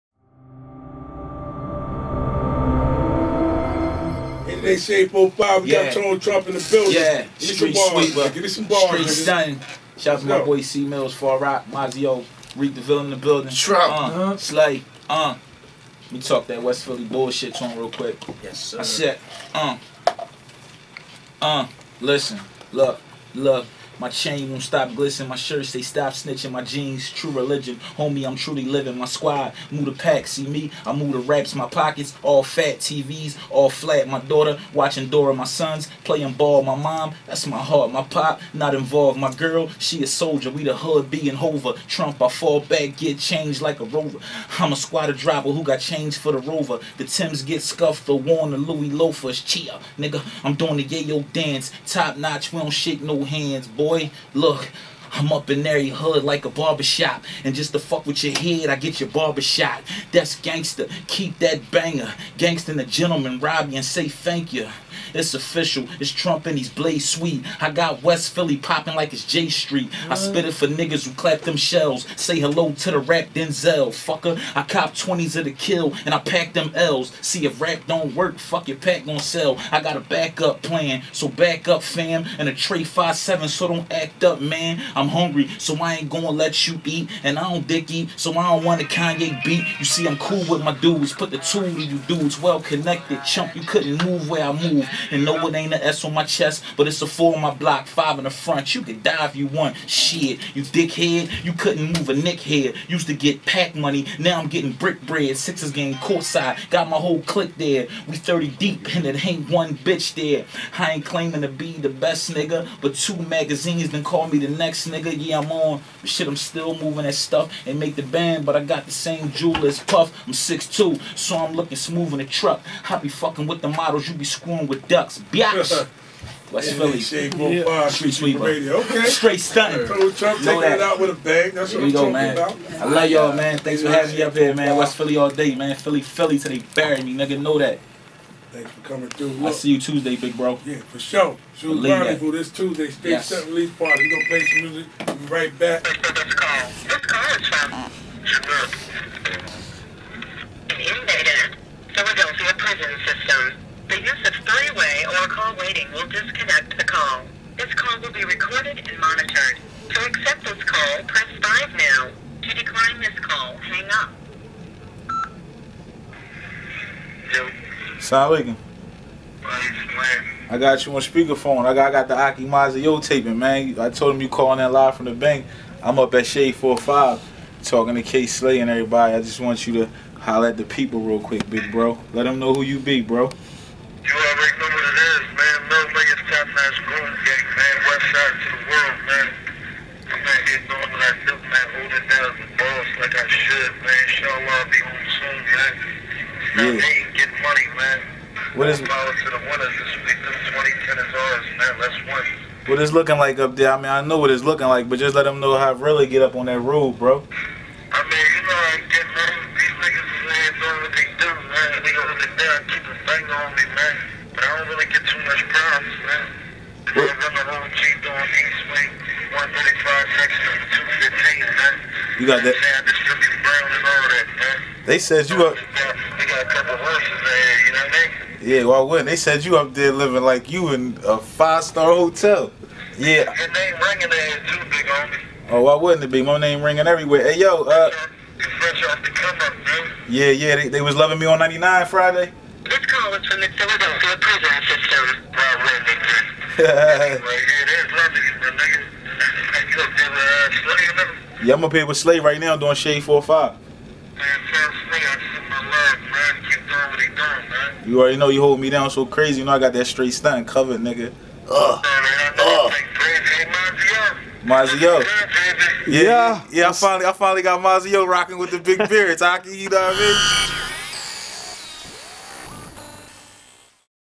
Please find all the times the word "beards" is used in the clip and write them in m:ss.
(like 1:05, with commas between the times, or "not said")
4:28.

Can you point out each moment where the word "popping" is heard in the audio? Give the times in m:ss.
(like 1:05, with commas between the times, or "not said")
1:08.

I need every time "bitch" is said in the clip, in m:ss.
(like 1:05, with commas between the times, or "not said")
1:49.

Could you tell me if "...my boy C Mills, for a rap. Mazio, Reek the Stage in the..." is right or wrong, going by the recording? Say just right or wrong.
wrong.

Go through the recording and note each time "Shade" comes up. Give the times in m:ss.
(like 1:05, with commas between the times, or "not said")
2:06, 2:56, 4:12.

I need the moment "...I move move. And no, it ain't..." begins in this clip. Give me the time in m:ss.
1:34.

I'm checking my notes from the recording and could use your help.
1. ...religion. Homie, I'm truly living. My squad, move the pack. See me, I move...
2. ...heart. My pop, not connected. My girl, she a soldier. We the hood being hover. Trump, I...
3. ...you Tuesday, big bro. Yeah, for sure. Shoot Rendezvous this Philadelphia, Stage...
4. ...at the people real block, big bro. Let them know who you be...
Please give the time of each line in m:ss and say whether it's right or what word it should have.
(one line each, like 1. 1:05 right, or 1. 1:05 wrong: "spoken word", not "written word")
1. 0:27 right
2. 0:37 wrong: "involved", not "connected"
3. 2:19 wrong: "Tuesday", not "Philadelphia"
4. 3:00 wrong: "quick", not "block".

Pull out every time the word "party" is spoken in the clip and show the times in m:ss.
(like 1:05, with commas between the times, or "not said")
2:23.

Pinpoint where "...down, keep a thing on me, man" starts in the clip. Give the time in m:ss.
3:32.